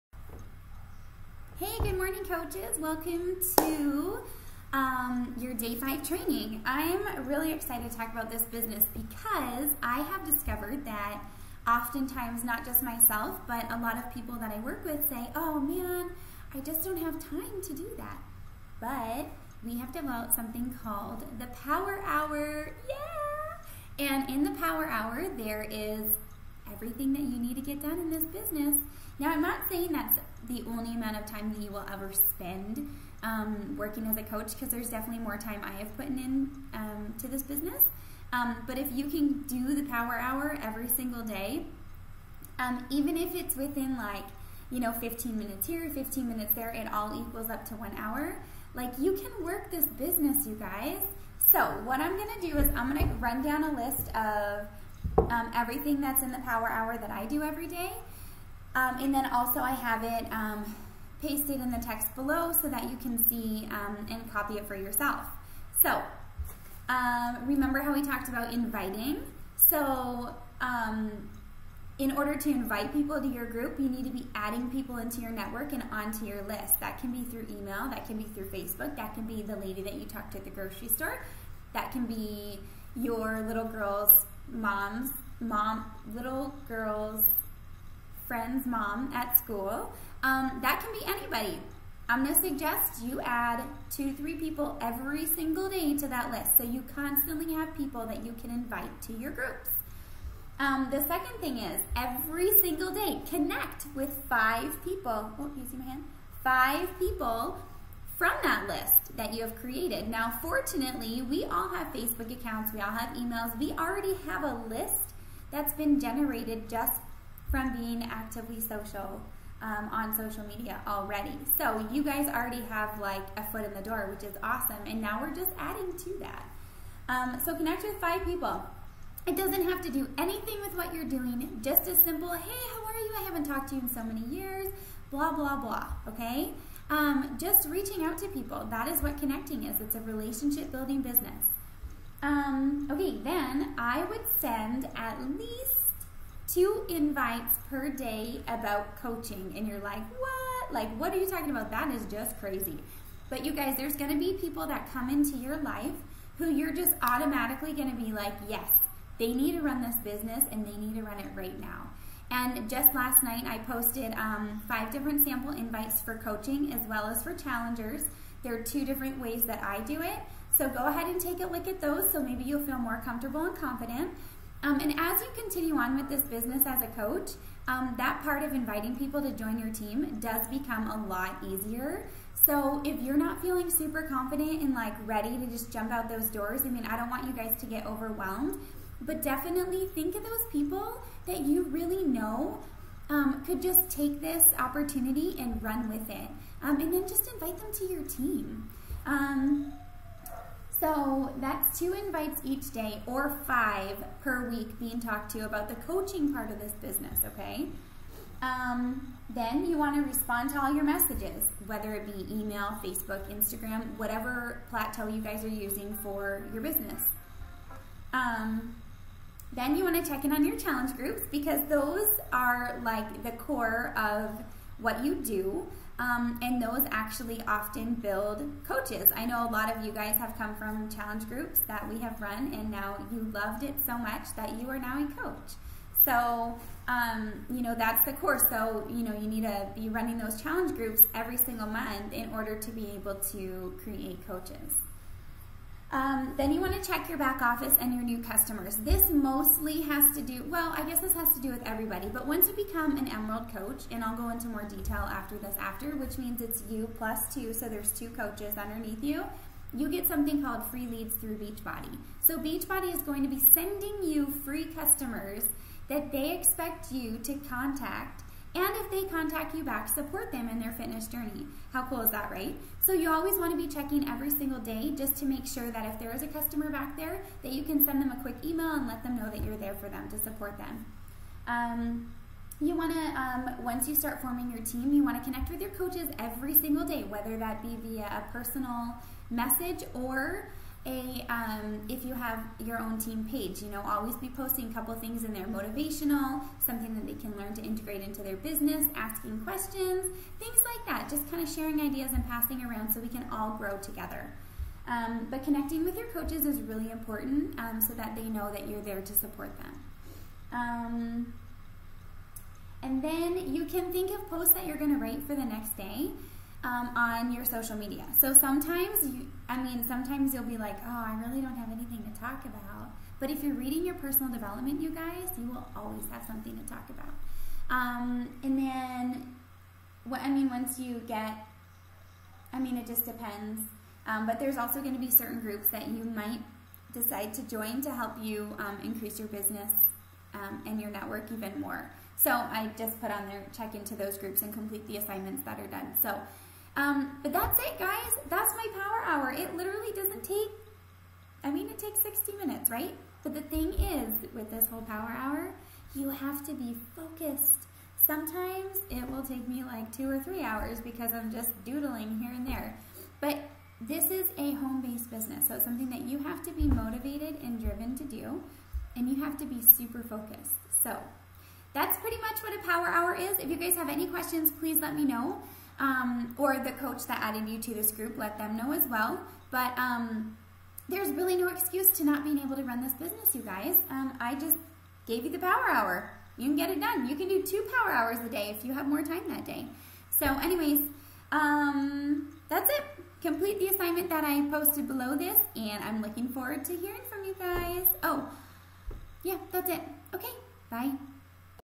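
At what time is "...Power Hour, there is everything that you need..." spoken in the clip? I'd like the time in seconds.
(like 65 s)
24 s.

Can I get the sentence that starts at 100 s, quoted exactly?
Um, the second thing is every single day connect with five people, oh, you see my hand?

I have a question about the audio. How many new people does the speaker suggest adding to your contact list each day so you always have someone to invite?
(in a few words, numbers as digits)
2 to 3.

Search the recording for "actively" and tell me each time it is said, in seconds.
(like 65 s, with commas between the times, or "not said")
118 s.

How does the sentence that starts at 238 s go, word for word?
So, you know, you need to be running those challenge groups every single month in order to be able to create coaches.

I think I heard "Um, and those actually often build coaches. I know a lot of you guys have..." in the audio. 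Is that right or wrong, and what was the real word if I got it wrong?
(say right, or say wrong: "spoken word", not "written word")
right.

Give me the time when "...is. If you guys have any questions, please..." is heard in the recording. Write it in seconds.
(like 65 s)
373 s.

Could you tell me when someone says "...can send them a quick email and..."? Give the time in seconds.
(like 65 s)
277 s.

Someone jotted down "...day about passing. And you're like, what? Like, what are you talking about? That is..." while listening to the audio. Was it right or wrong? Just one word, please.
wrong.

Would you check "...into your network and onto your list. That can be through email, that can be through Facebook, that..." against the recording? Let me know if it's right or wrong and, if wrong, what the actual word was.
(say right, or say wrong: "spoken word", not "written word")
right.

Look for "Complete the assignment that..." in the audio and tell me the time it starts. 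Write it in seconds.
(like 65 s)
393 s.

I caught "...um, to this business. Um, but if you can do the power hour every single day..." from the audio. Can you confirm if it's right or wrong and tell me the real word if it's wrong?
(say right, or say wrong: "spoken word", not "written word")
right.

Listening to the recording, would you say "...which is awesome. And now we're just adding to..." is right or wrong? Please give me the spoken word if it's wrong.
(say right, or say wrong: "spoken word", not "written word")
right.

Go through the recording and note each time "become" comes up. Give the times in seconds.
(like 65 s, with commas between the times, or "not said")
180 s, 252 s.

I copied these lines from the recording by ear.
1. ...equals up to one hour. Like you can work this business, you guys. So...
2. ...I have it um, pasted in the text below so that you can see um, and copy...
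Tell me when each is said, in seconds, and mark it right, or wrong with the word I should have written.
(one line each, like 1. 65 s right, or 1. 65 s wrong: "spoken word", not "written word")
1. 47 s right
2. 59 s right.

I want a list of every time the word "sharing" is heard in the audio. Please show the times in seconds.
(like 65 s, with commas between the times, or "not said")
301 s.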